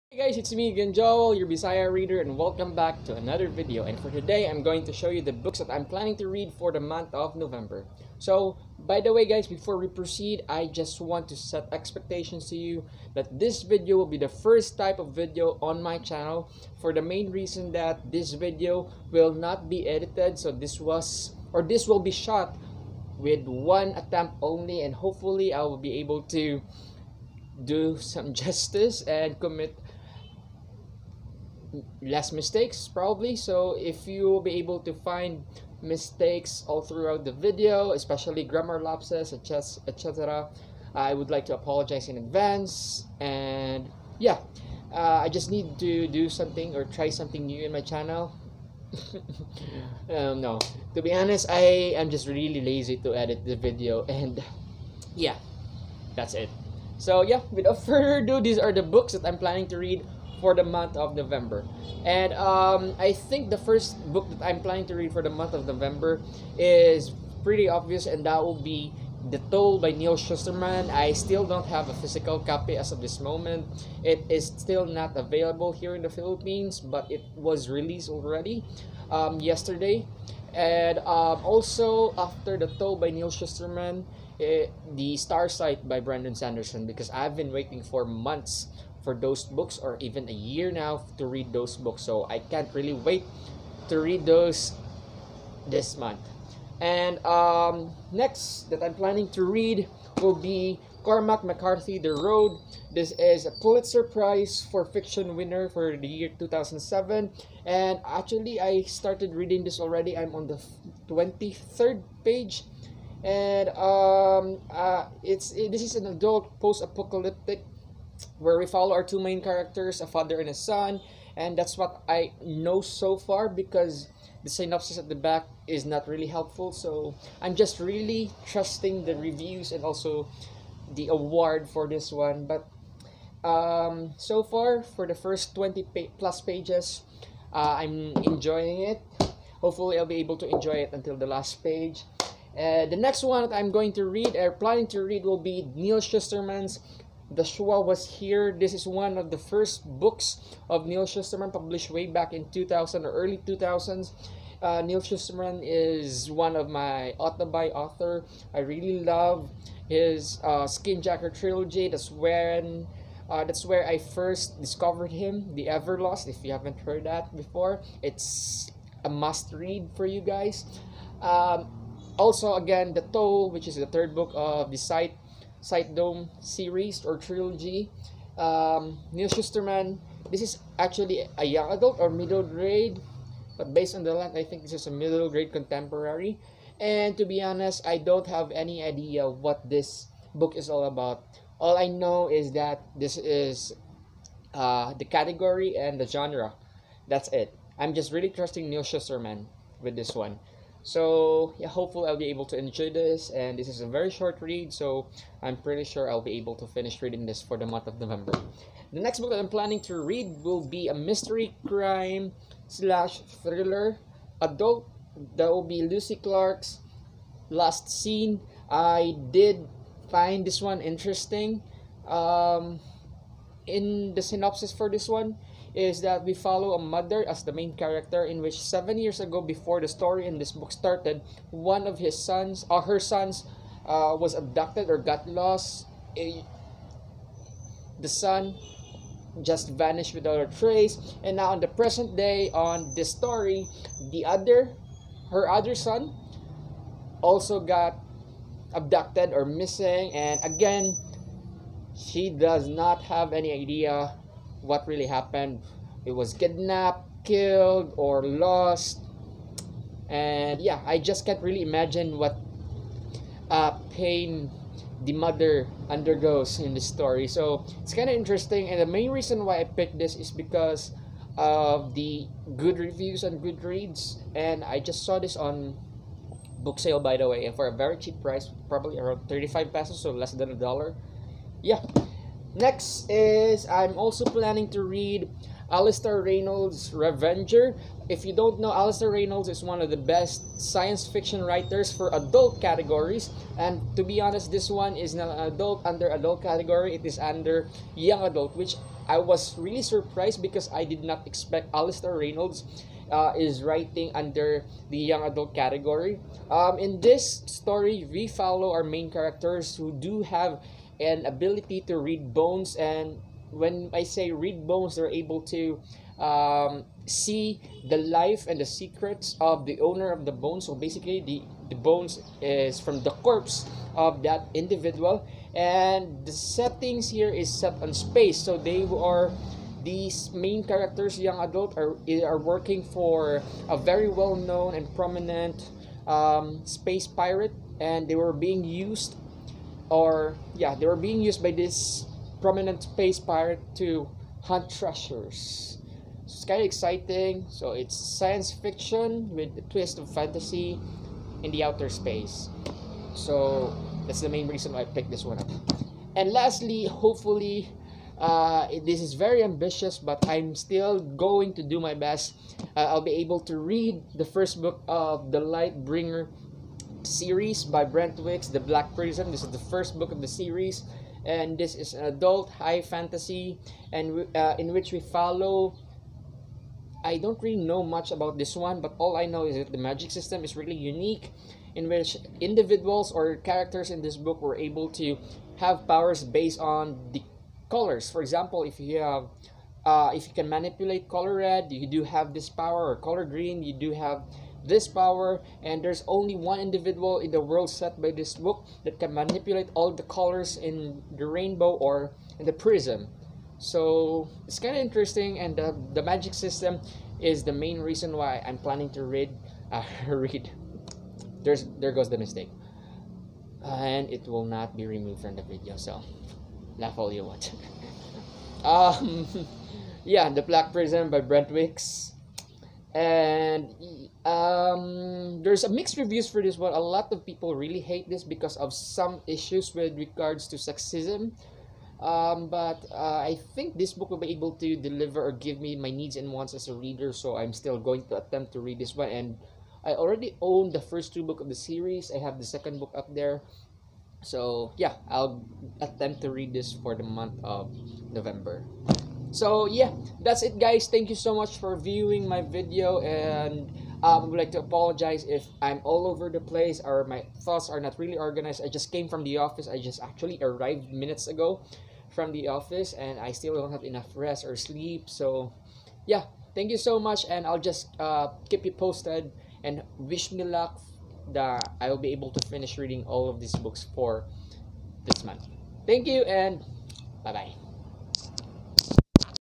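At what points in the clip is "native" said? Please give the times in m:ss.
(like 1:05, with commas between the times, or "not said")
not said.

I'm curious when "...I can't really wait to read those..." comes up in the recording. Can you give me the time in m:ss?
1:32.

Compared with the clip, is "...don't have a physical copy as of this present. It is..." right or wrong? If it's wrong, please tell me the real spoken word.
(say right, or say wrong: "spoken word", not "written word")
wrong: "moment", not "present".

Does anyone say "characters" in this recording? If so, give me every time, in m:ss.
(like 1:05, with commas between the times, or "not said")
1:59, 3:47, 5:09, 5:30, 6:23.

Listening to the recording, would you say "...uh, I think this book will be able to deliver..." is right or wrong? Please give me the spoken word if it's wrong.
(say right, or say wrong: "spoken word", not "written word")
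right.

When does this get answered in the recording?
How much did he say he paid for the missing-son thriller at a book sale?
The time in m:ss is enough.
4:39.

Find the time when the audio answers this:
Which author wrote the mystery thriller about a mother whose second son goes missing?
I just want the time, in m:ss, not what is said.
3:35.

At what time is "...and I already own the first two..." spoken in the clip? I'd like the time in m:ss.
7:19.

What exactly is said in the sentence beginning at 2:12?
But um, so far, for the first 20 pa plus pages, uh, I'm enjoying it.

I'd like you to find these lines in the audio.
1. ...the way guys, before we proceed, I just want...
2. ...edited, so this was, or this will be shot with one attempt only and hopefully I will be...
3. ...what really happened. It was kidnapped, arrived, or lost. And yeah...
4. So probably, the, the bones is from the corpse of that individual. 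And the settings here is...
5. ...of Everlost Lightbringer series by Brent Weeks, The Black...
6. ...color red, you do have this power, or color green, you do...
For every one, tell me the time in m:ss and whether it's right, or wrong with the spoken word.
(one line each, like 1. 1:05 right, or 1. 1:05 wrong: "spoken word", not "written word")
1. 0:09 right
2. 0:19 right
3. 4:14 wrong: "killed", not "arrived"
4. 5:20 wrong: "basically", not "probably"
5. 6:04 wrong: "The", not "Everlost"
6. 6:31 right.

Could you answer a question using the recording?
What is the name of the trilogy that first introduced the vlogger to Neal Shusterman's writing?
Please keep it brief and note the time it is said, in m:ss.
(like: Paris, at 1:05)
Skinjacker trilogy, at 2:40.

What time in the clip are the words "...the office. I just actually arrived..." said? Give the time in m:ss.
7:39.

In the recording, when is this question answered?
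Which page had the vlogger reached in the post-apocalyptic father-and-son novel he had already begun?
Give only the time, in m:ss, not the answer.
1:51.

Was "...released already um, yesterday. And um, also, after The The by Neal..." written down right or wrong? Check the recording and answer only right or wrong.
wrong.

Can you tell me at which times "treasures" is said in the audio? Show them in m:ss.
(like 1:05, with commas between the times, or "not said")
5:44.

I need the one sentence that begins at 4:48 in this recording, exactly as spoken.
If you don't know, Alastair Reynolds is one of the best science fiction writers for adult categories.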